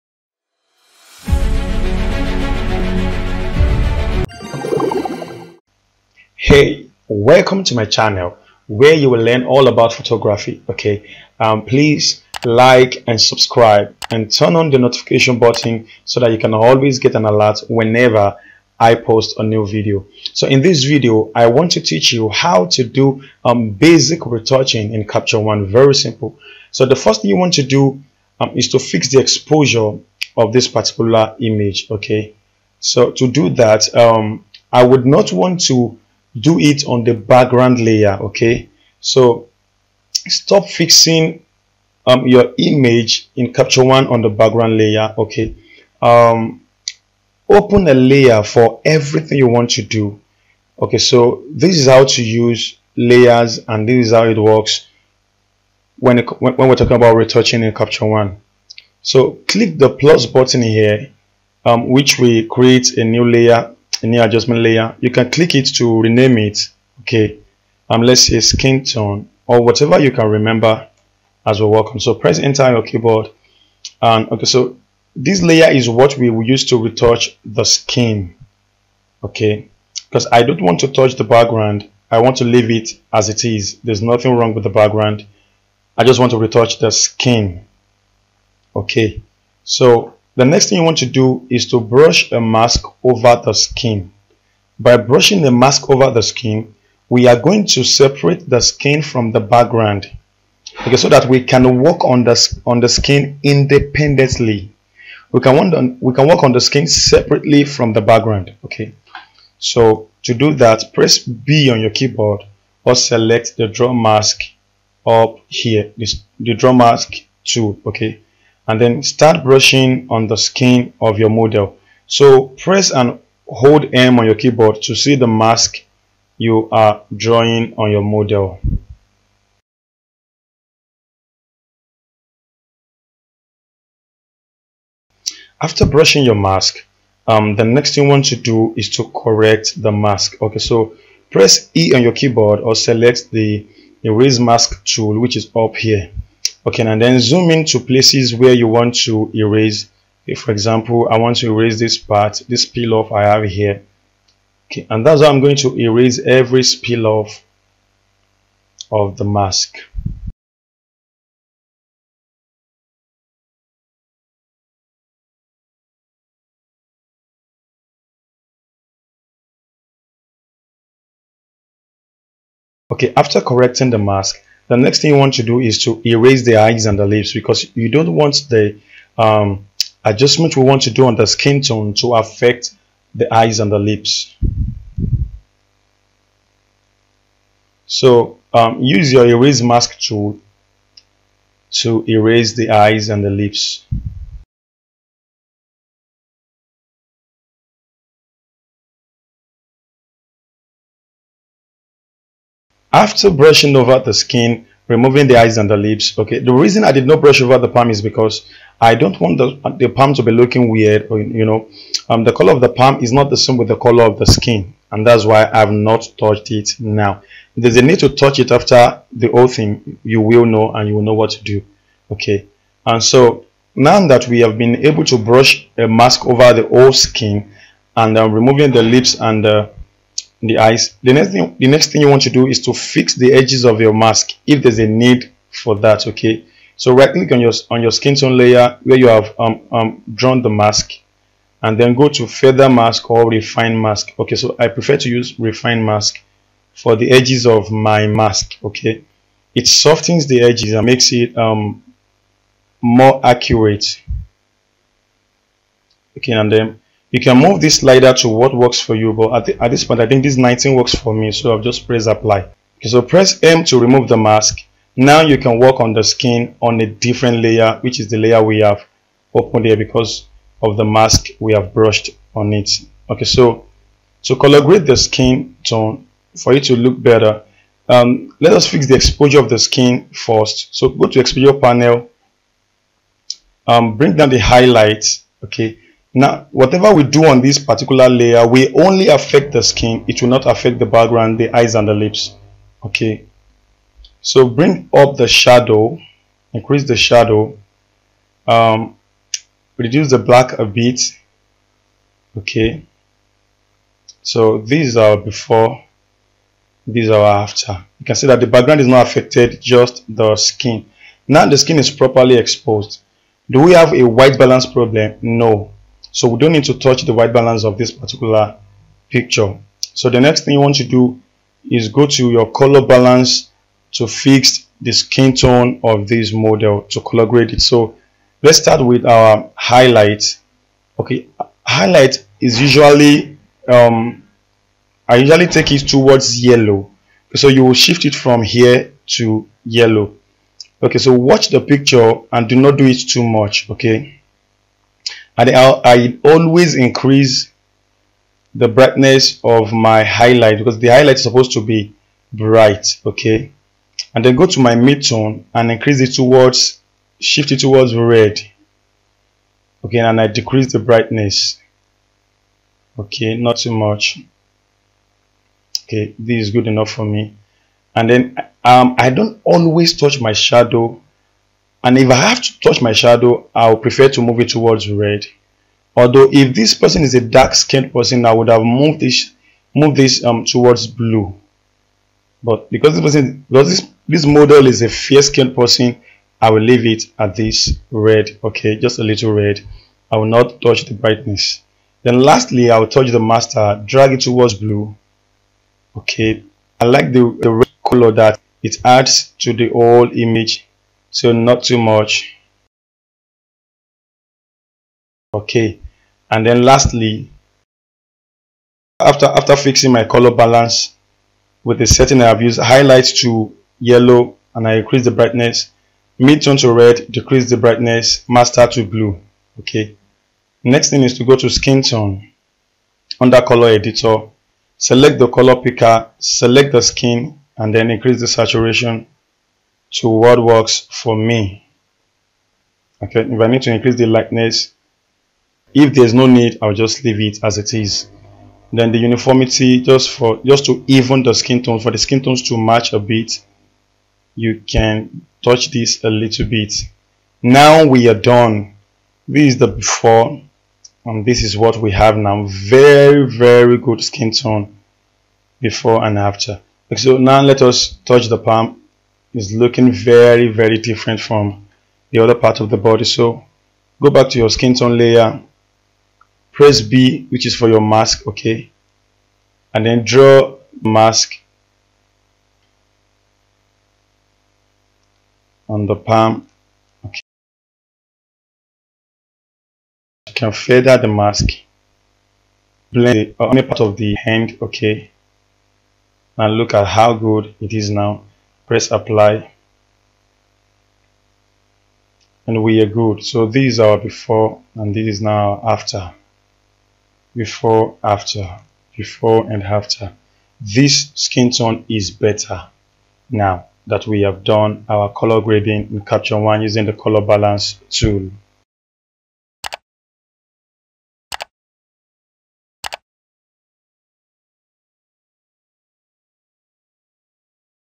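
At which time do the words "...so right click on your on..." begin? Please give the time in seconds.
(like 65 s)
236 s.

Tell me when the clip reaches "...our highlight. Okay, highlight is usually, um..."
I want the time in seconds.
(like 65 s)
329 s.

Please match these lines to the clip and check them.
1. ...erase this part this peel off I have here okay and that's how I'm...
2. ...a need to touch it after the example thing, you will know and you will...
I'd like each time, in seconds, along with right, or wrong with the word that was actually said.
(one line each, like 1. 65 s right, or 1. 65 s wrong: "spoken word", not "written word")
1. 151 s right
2. 217 s wrong: "whole", not "example".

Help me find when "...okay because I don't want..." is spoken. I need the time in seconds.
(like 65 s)
79 s.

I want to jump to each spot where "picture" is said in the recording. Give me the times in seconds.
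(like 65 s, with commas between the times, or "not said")
319 s, 341 s.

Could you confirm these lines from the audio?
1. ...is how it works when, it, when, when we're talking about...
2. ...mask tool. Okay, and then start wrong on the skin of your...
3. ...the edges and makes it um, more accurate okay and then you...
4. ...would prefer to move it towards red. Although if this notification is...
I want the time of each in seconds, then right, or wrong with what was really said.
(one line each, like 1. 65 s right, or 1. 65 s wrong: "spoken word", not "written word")
1. 54 s right
2. 116 s wrong: "brushing", not "wrong"
3. 250 s right
4. 373 s wrong: "person", not "notification".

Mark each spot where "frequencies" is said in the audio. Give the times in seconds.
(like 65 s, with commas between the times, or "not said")
not said.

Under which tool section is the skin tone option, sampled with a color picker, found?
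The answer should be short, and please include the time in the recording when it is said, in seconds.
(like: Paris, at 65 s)
Color editor, at 423 s.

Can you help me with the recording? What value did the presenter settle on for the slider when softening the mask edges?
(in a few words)
19.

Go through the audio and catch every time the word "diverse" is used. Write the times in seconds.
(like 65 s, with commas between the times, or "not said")
not said.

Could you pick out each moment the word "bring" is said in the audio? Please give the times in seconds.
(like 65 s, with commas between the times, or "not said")
283 s, 294 s.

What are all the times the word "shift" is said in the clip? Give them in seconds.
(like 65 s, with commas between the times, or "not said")
337 s, 357 s.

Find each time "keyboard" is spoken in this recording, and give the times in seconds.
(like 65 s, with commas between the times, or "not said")
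72 s, 111 s, 124 s, 142 s.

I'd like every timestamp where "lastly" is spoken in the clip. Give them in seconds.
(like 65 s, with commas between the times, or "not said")
392 s, 406 s.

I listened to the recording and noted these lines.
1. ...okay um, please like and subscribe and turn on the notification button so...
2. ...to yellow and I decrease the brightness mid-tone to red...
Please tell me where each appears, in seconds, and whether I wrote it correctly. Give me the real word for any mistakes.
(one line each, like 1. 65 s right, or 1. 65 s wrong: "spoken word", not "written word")
1. 10 s right
2. 413 s wrong: "increase", not "decrease".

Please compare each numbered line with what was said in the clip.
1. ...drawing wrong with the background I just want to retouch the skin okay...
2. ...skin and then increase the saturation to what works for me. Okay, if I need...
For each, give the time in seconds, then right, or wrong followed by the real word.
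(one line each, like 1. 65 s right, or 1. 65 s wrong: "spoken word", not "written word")
1. 84 s wrong: "nothing", not "drawing"
2. 426 s right.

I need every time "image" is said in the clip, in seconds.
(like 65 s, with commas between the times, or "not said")
31 s, 42 s, 400 s.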